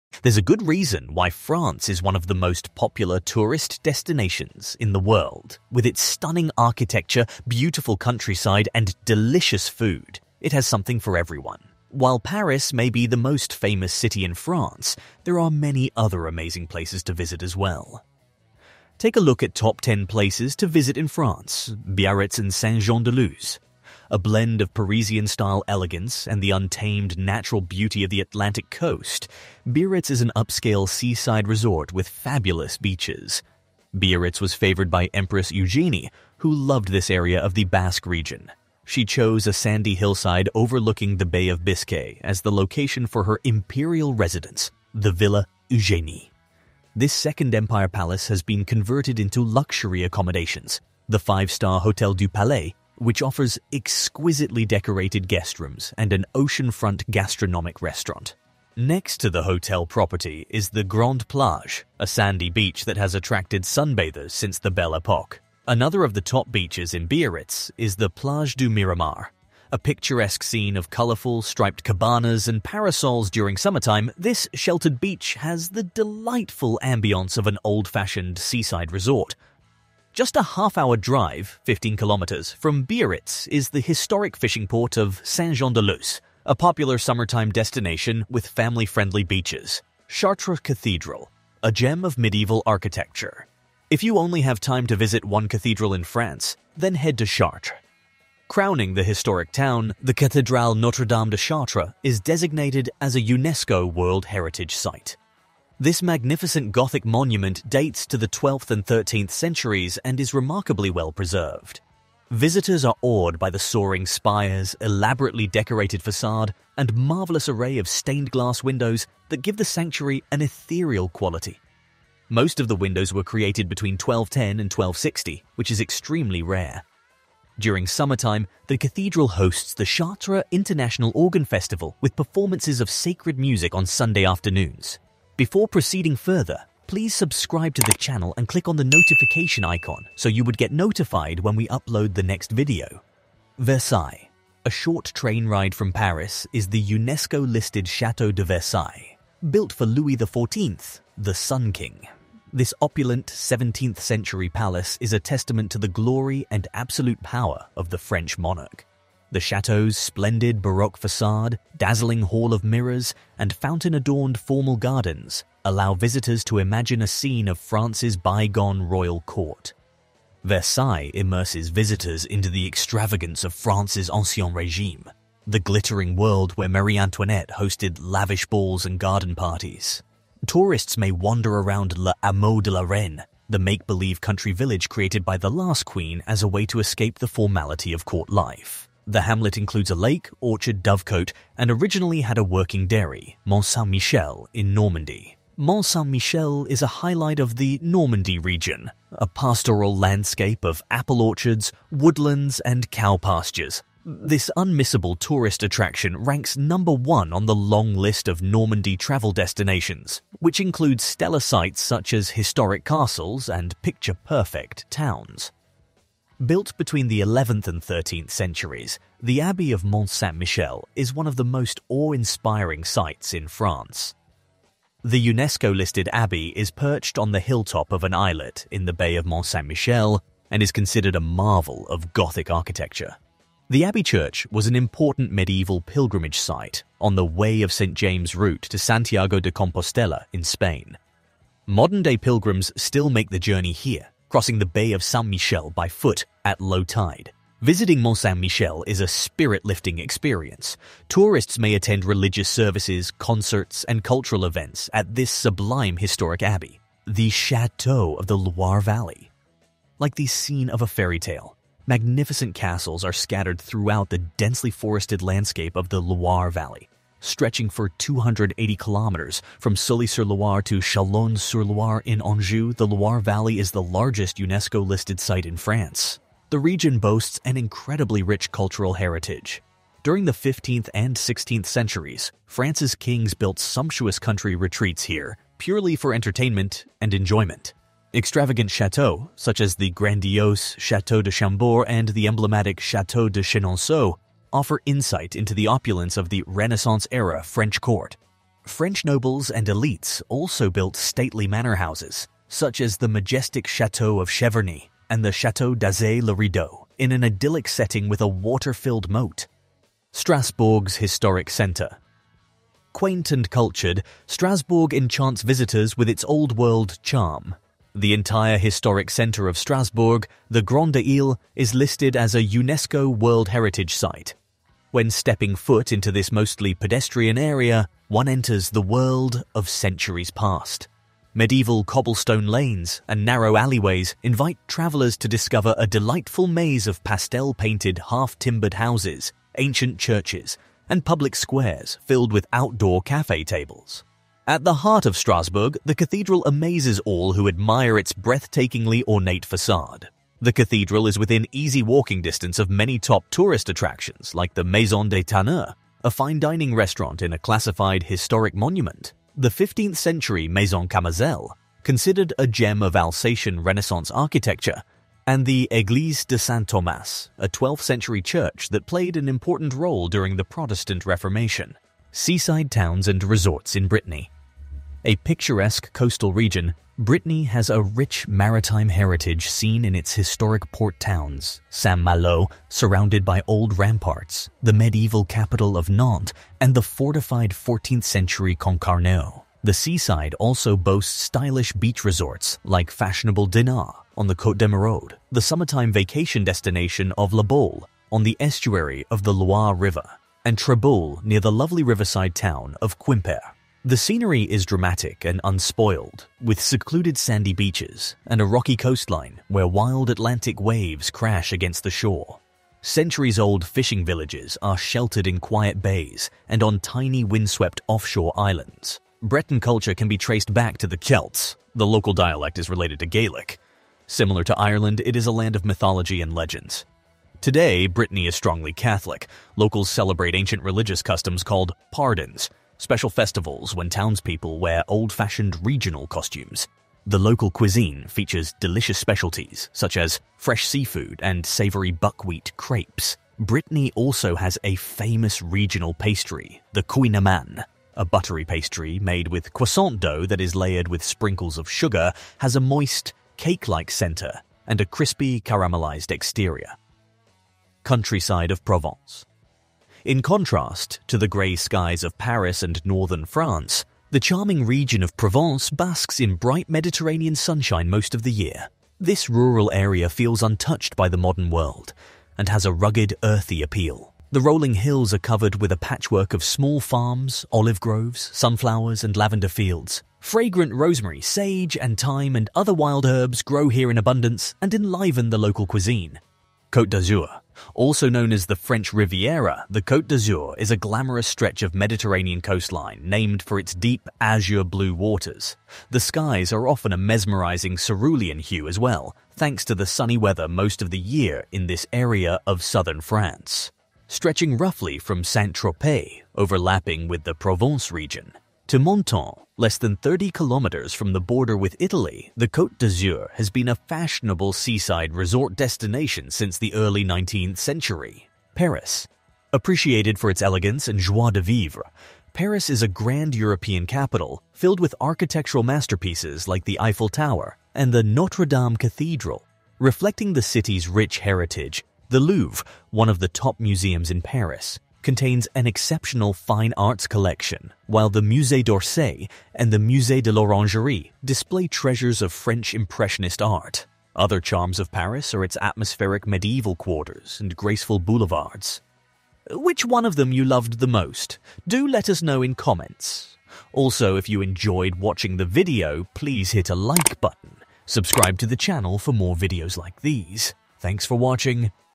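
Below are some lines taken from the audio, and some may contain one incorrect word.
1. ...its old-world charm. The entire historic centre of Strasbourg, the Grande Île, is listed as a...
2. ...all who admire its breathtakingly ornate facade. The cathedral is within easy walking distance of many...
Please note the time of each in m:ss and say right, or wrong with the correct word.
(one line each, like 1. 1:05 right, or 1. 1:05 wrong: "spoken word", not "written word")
1. 5:16 right
2. 5:47 right.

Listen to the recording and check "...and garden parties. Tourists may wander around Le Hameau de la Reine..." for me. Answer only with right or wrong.
right.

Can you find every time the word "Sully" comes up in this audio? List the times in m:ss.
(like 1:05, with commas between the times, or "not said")
4:29.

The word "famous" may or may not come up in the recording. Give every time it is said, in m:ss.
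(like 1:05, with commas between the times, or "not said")
0:13, 7:24.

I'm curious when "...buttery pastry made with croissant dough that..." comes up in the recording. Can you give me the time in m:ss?
7:28.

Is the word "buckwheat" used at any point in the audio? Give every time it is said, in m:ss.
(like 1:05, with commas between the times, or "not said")
7:21.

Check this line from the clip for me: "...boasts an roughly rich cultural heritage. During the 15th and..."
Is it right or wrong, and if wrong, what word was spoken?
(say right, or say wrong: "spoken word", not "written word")
wrong: "incredibly", not "roughly".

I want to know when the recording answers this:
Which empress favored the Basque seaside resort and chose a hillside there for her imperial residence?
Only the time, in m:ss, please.
0:35.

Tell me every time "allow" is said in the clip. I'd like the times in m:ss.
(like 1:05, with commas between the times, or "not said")
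2:45.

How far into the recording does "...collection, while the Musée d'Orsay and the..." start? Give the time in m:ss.
8:57.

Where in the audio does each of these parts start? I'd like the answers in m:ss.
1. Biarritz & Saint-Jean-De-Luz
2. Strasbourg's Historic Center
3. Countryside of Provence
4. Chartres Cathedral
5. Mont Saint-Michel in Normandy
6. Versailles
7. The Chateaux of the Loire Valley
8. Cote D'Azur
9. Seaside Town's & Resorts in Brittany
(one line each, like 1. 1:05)
1. 0:22
2. 5:10
3. 7:38
4. 1:30
5. 3:13
6. 2:24
7. 4:18
8. 8:09
9. 6:12.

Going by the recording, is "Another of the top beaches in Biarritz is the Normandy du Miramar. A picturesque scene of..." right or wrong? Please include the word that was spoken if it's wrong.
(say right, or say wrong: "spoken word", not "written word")
wrong: "Plage", not "Normandy".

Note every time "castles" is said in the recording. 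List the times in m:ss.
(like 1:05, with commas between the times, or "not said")
3:32, 4:22.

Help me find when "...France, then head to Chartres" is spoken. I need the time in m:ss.
1:36.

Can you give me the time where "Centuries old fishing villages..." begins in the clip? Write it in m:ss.
6:52.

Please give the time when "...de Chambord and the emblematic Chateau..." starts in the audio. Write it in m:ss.
4:51.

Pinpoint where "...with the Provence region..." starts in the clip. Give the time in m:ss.
8:27.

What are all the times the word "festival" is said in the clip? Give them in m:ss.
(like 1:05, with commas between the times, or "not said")
2:11, 7:13.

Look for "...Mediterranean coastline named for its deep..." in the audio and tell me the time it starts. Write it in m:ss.
8:11.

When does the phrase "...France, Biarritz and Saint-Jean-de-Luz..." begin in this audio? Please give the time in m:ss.
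0:21.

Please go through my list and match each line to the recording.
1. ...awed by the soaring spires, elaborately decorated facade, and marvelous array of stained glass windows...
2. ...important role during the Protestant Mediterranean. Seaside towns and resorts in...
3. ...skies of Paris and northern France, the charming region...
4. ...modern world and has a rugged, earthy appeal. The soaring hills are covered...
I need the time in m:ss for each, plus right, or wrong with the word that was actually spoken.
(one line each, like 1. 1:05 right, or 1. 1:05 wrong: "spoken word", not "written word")
1. 1:53 right
2. 6:09 wrong: "Reformation", not "Mediterranean"
3. 7:41 right
4. 7:51 wrong: "rolling", not "soaring".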